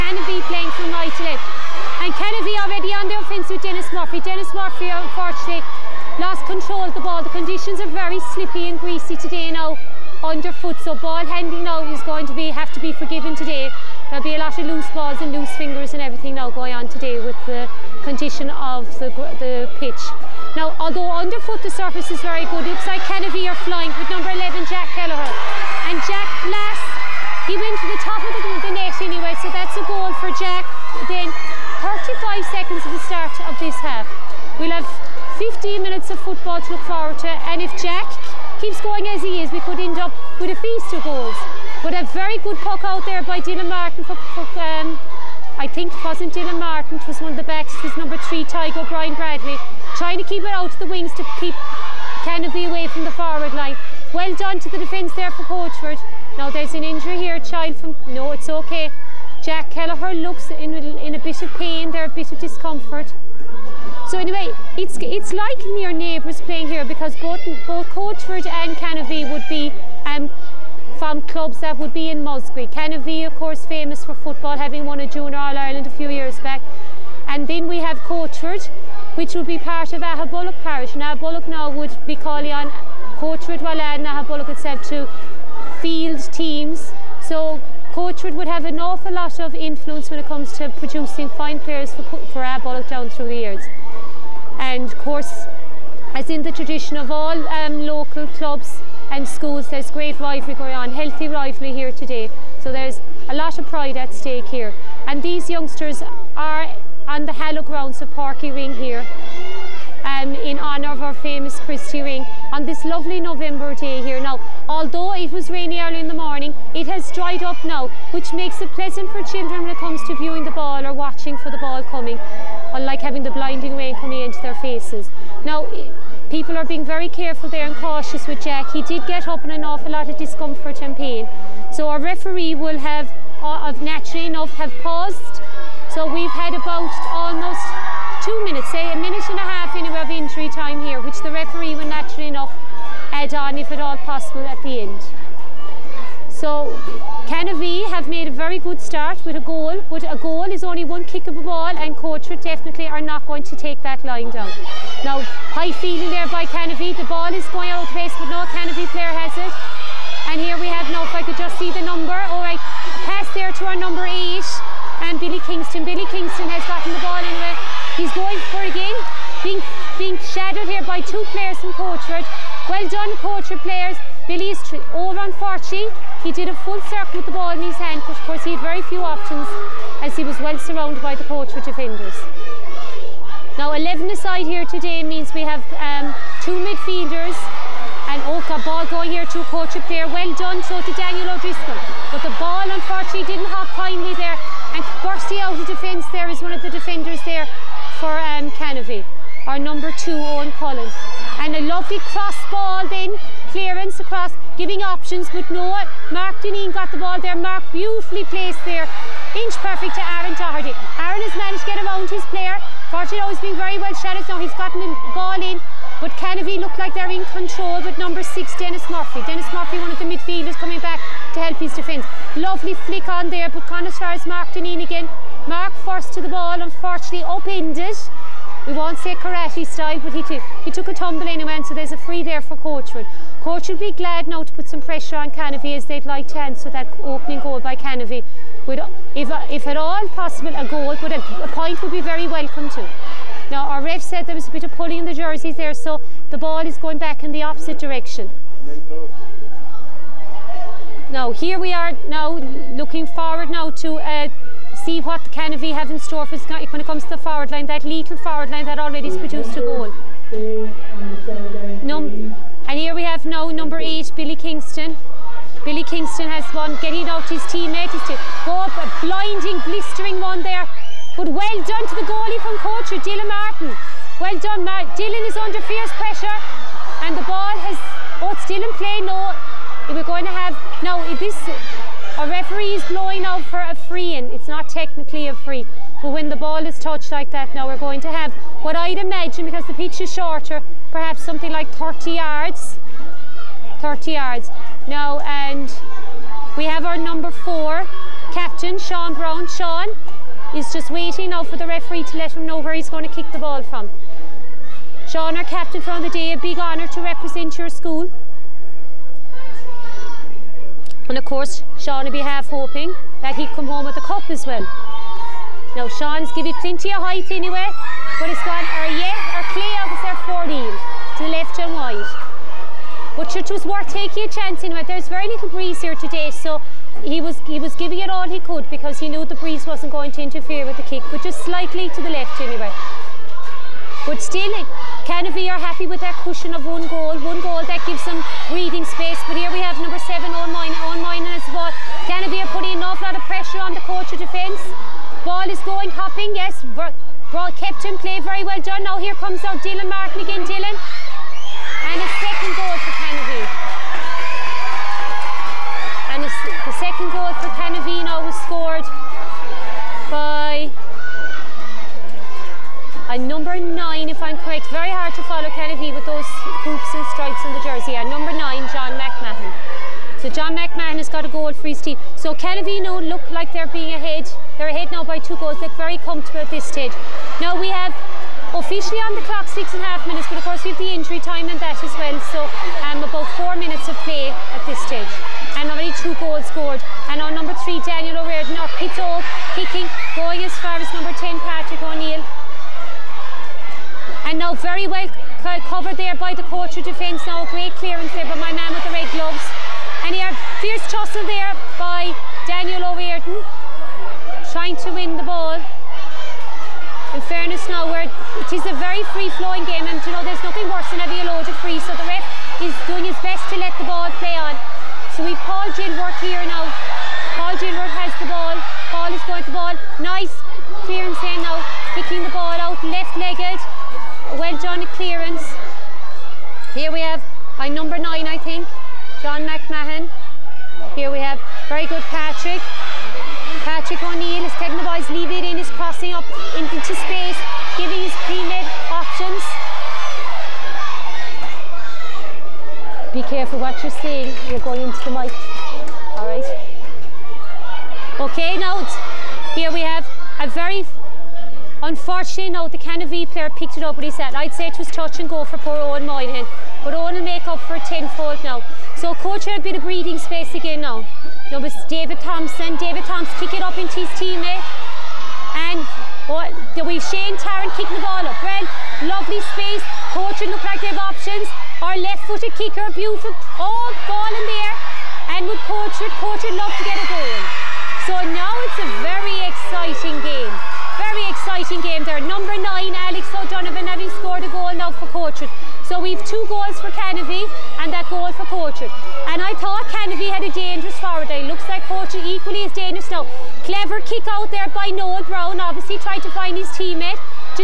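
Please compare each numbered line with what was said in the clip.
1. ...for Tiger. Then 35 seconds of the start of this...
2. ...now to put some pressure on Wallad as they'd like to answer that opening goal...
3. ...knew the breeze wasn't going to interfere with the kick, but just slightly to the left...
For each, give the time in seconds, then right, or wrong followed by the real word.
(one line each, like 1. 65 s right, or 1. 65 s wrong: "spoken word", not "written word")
1. 30 s wrong: "Jack", not "Tiger"
2. 234 s wrong: "Canovee", not "Wallad"
3. 329 s right.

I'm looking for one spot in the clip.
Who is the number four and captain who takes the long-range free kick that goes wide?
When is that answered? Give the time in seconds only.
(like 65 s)
298 s.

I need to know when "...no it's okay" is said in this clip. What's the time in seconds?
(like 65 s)
58 s.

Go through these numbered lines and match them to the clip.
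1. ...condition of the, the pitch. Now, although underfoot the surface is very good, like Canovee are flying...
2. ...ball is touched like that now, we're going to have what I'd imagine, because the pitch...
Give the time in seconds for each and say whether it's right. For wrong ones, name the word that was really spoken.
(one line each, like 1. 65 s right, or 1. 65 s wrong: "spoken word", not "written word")
1. 18 s right
2. 286 s right.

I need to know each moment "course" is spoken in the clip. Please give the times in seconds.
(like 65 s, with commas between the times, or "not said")
73 s, 94 s, 178 s, 311 s, 380 s.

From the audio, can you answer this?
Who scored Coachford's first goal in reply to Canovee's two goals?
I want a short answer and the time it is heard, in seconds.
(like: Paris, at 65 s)
Alex O'Donovan, at 482 s.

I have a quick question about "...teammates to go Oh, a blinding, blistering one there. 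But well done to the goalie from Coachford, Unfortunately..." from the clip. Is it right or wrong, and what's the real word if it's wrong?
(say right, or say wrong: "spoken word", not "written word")
wrong: "Dylan", not "Unfortunately".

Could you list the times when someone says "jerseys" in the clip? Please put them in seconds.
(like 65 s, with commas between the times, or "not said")
245 s, 367 s.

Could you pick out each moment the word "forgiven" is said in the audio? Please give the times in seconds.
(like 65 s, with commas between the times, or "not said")
12 s.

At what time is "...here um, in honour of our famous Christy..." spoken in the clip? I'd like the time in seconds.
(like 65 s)
108 s.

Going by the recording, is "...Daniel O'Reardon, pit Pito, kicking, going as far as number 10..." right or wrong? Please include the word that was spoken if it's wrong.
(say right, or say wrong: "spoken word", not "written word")
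right.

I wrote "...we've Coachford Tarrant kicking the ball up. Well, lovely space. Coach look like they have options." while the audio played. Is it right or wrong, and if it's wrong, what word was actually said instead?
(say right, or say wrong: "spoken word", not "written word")
wrong: "Shane", not "Coachford".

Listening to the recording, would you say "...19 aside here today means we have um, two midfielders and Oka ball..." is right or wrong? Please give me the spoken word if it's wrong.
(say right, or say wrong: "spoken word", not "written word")
wrong: "11", not "19".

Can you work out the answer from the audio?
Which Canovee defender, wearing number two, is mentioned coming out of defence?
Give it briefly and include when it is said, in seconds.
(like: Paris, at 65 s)
Owen Cullen, at 200 s.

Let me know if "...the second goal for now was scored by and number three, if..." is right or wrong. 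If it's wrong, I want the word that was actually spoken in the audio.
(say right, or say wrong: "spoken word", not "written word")
wrong: "nine", not "three".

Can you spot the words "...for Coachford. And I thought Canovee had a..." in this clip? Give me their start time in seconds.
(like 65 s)
488 s.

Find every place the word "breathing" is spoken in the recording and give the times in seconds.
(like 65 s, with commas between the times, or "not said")
338 s, 459 s.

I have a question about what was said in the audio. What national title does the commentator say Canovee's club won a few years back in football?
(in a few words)
Junior All-Ireland.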